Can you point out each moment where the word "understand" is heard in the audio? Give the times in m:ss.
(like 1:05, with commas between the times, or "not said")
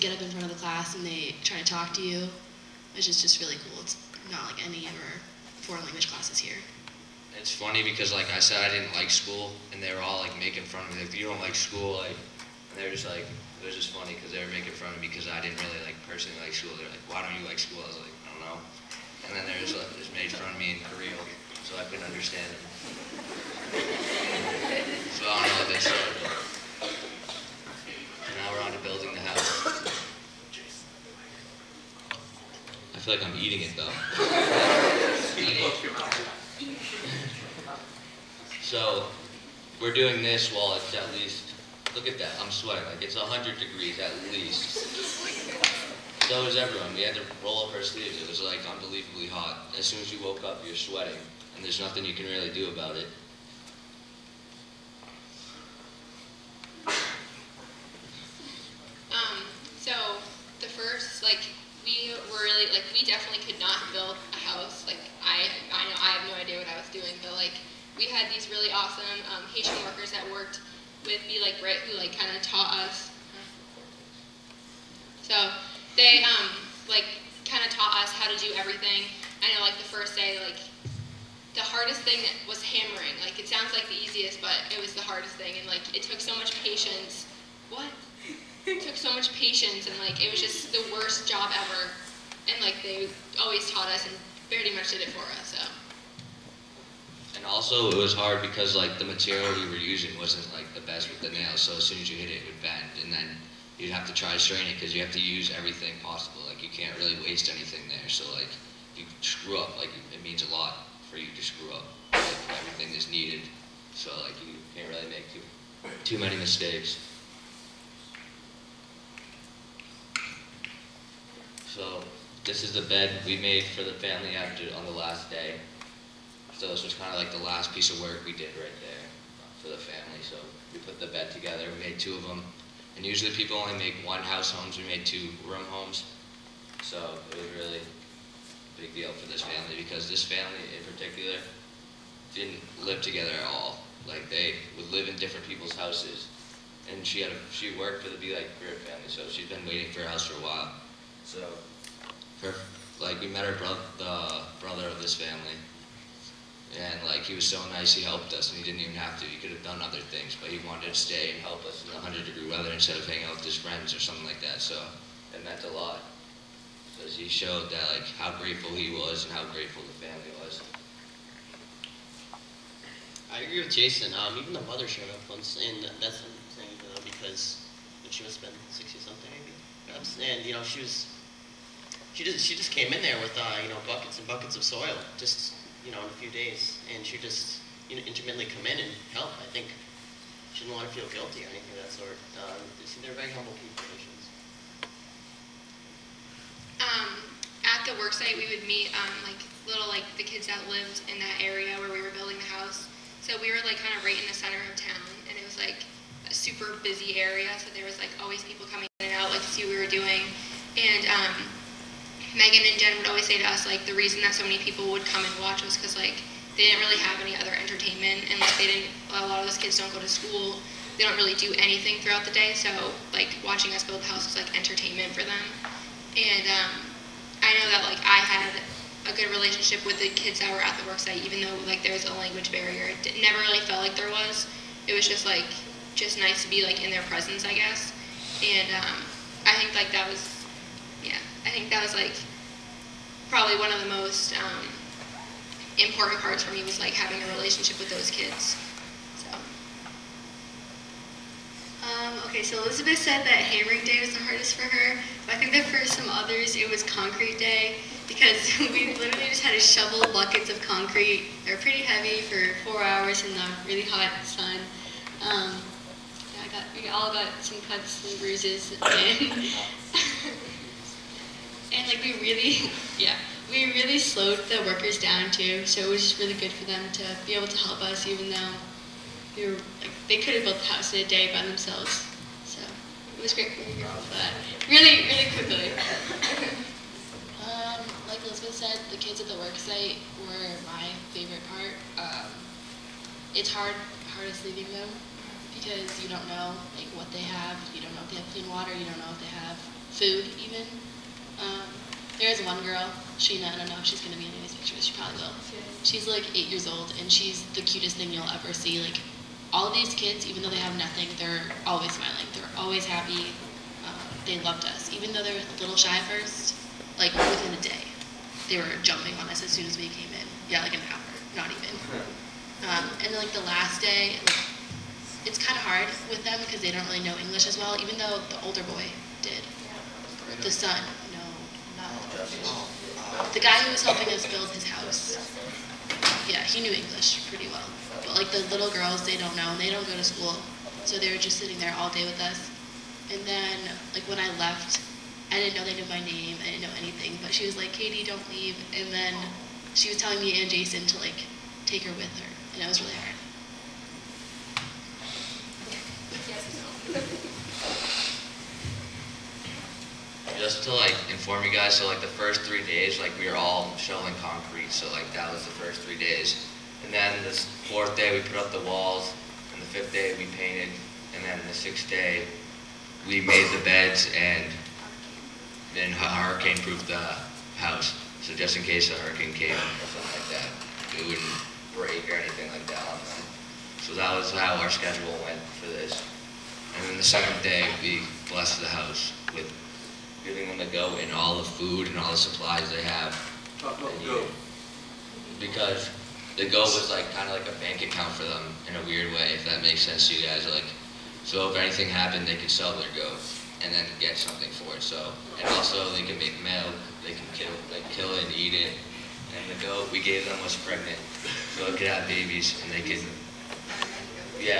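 0:22.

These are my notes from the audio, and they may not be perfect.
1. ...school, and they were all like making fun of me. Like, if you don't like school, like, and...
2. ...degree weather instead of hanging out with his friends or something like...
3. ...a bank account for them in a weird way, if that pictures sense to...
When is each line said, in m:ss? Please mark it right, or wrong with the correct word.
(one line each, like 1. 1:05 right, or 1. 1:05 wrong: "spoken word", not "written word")
1. 0:09 right
2. 2:42 right
3. 6:37 wrong: "makes", not "pictures".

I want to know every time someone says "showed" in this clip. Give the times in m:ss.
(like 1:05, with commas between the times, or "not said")
2:47, 2:54.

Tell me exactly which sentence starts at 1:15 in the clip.
So, they um, like kind of taught us how to do everything.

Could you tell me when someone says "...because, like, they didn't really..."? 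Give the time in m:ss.
3:35.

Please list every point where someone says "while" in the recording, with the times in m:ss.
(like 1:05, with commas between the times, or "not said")
0:40, 2:30.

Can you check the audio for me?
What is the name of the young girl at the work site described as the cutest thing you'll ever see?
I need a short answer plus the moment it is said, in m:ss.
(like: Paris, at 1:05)
Sheena, at 5:03.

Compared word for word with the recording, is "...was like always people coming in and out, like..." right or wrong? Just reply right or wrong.
right.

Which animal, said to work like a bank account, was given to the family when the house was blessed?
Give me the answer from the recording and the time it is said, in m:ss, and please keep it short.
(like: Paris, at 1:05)
Goat, at 6:49.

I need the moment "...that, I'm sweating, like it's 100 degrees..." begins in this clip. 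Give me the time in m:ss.
0:42.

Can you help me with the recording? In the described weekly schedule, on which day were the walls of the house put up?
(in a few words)
Fourth day.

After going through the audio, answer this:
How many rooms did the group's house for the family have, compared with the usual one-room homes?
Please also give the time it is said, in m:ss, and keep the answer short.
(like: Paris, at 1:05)
2, at 2:15.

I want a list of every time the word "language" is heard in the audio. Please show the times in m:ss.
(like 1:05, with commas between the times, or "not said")
0:05, 3:52.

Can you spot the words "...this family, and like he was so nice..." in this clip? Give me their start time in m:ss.
2:35.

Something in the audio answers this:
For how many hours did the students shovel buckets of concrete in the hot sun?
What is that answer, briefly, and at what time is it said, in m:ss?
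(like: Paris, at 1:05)
4, at 4:22.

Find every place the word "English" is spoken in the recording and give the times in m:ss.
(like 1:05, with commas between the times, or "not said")
5:27, 5:36.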